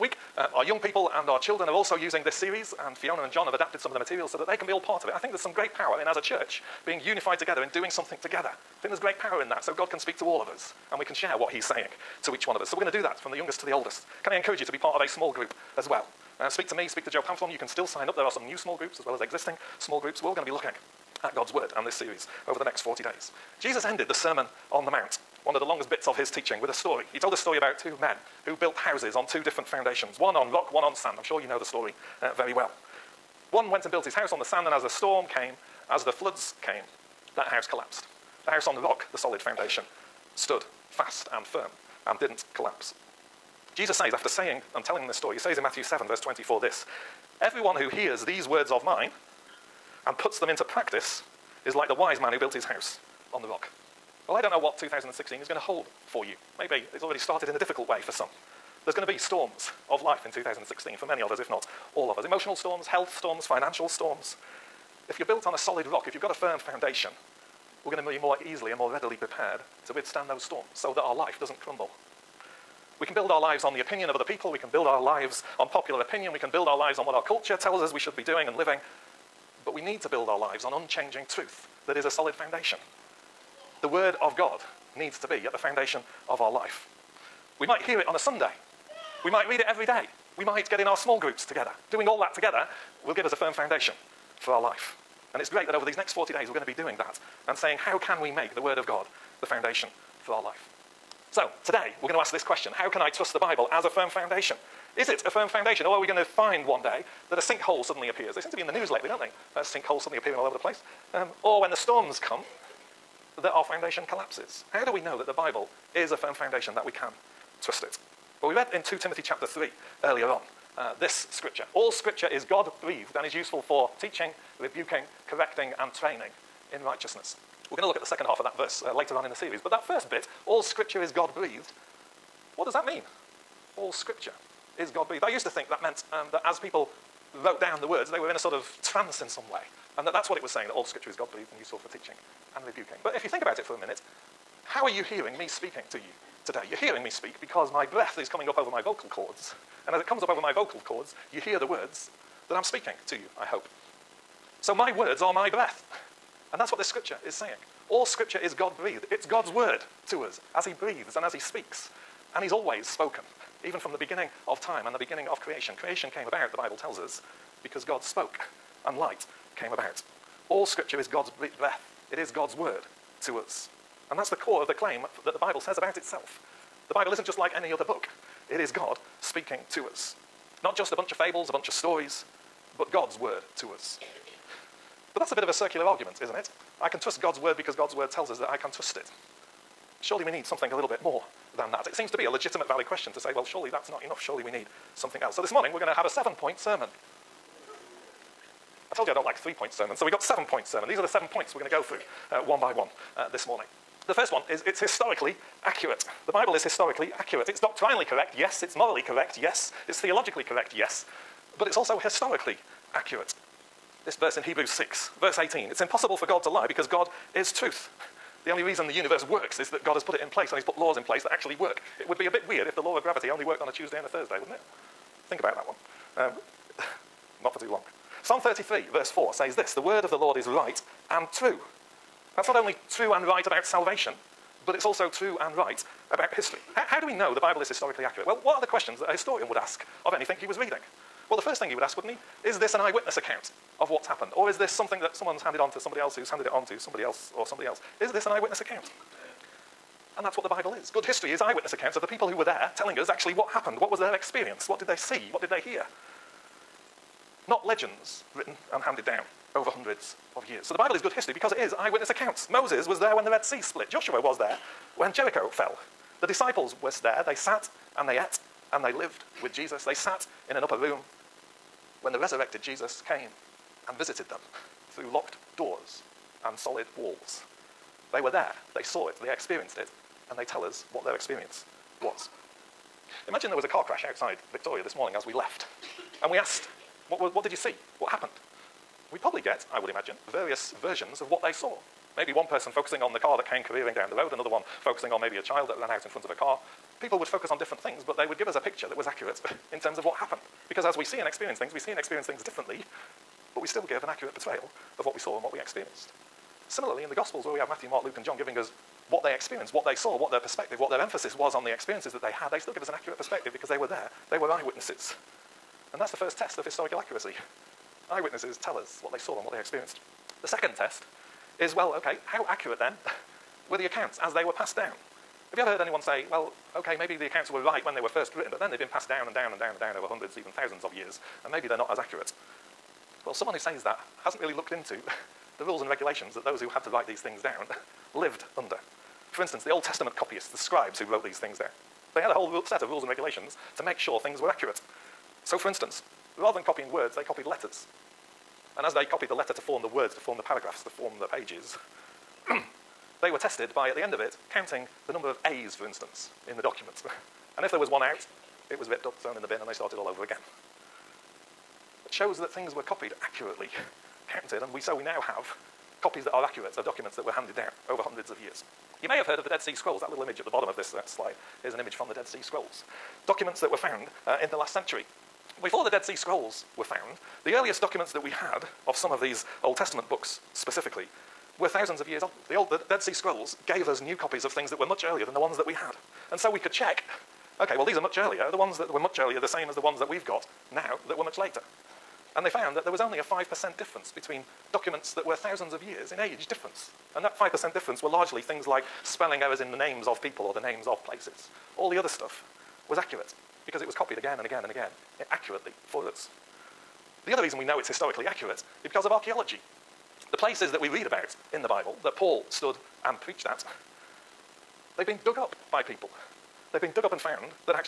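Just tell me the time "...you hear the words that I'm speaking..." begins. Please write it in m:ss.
2:31.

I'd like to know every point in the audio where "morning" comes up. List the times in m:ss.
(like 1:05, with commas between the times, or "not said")
3:15, 3:23, 4:44.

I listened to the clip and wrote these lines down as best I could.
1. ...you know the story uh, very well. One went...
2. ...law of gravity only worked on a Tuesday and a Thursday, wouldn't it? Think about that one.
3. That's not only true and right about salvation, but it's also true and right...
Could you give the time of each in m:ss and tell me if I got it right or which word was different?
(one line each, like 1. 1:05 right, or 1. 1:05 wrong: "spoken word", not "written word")
1. 0:31 right
2. 3:42 right
3. 3:52 right.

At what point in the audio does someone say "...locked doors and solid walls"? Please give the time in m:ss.
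4:35.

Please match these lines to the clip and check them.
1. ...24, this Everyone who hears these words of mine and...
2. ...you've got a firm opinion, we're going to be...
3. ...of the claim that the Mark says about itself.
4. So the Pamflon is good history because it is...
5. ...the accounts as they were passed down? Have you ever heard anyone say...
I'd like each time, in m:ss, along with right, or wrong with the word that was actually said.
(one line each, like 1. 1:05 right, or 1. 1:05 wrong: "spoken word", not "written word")
1. 0:46 right
2. 1:06 wrong: "foundation", not "opinion"
3. 2:54 wrong: "Bible", not "Mark"
4. 4:20 wrong: "Bible", not "Pamflon"
5. 5:23 right.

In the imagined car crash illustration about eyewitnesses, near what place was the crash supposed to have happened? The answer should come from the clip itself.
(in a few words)
Victoria.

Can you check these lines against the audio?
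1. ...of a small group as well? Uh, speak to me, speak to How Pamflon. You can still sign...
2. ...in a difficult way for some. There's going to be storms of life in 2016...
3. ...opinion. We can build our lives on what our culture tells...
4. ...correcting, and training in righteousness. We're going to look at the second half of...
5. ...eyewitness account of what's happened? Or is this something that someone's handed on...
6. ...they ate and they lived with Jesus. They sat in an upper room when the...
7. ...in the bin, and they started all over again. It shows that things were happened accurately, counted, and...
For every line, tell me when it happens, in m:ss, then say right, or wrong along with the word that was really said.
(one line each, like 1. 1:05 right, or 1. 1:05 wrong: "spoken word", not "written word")
1. 0:14 wrong: "Joe", not "How"
2. 0:57 right
3. 1:16 right
4. 2:05 right
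5. 4:02 right
6. 4:28 right
7. 5:59 wrong: "copied", not "happened".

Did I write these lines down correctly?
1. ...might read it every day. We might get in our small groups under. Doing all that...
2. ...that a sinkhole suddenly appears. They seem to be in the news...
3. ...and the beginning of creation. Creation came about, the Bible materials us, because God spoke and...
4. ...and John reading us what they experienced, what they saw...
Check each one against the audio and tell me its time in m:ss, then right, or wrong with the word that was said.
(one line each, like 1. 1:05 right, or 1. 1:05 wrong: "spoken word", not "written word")
1. 1:29 wrong: "together", not "under"
2. 1:47 right
3. 2:44 wrong: "tells", not "materials"
4. 5:08 wrong: "giving", not "reading".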